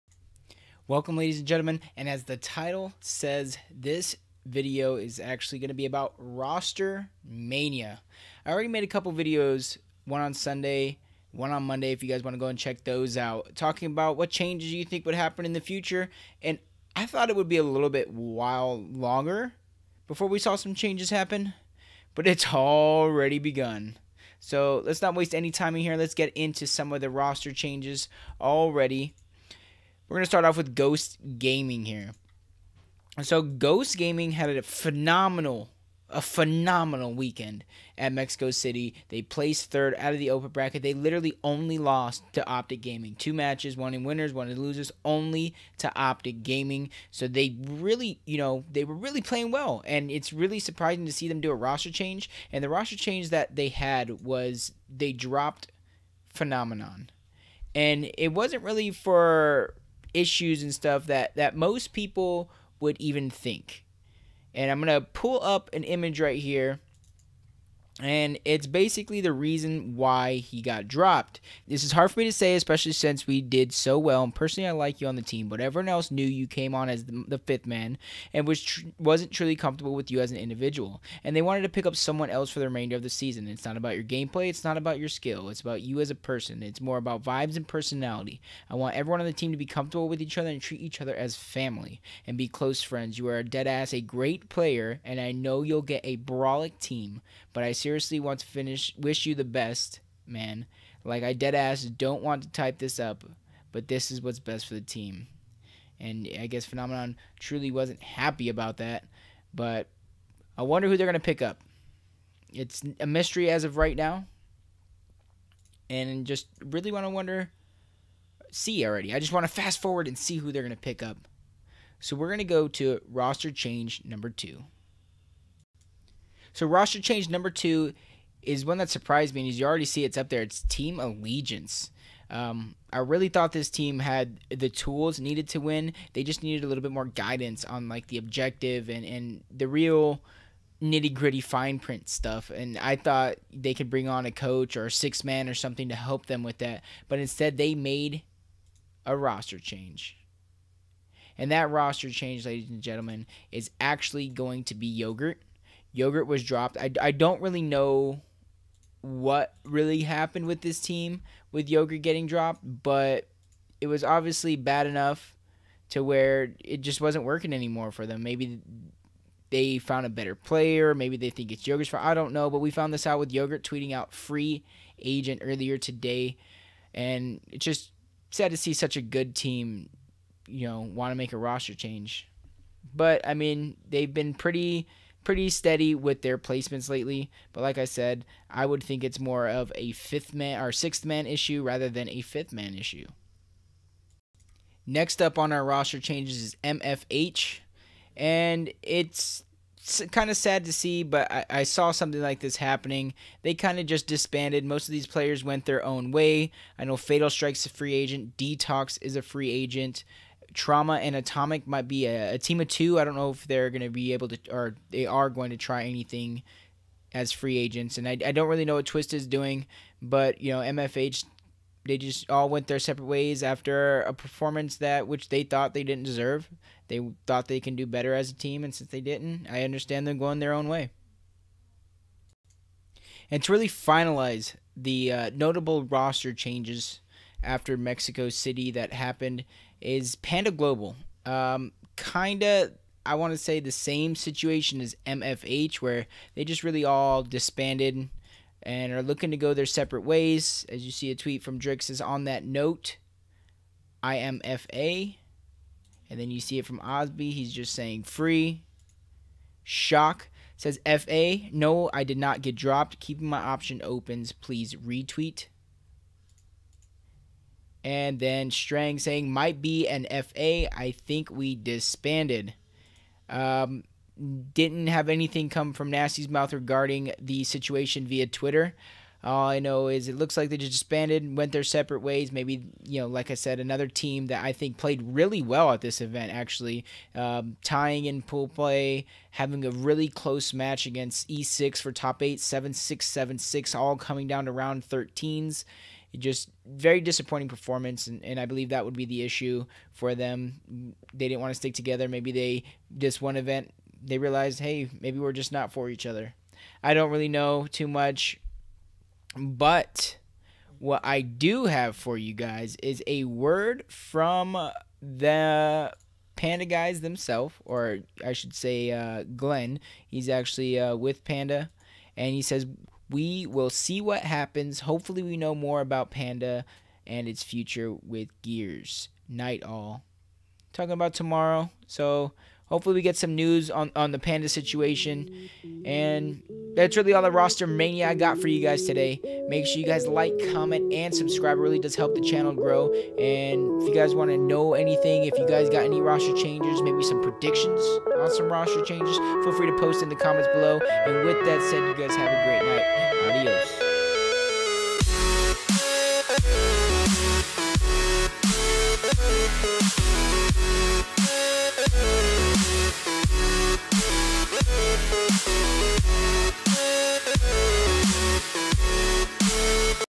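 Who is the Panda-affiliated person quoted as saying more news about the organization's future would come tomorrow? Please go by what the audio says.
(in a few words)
Glenn.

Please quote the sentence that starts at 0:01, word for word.
And as the title says, this video is actually going to be about roster mania.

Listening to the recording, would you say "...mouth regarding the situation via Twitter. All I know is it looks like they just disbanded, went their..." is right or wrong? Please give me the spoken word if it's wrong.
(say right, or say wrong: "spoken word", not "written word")
right.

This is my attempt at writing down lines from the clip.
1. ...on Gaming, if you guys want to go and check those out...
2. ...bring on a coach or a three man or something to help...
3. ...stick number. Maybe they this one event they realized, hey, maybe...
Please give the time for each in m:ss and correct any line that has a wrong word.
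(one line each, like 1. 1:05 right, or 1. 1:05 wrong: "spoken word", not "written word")
1. 0:11 wrong: "Monday", not "Gaming"
2. 2:23 wrong: "six", not "three"
3. 5:01 wrong: "together", not "number".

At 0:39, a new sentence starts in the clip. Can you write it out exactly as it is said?
They placed third out of the open bracket.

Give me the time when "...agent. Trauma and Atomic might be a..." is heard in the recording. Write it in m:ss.
3:29.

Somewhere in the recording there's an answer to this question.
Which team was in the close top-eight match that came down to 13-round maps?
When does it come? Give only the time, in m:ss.
4:00.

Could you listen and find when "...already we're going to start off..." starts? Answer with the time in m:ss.
0:28.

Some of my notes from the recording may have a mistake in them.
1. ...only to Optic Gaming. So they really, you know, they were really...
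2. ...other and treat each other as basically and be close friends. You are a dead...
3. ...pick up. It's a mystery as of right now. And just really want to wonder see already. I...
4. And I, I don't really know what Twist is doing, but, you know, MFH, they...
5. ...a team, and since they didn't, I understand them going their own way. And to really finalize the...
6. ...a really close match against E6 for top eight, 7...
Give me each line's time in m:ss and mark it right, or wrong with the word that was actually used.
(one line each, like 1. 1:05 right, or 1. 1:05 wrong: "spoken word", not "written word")
1. 0:45 right
2. 1:30 wrong: "family", not "basically"
3. 1:51 right
4. 3:37 right
5. 3:48 right
6. 4:49 right.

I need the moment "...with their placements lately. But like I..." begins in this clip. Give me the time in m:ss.
3:05.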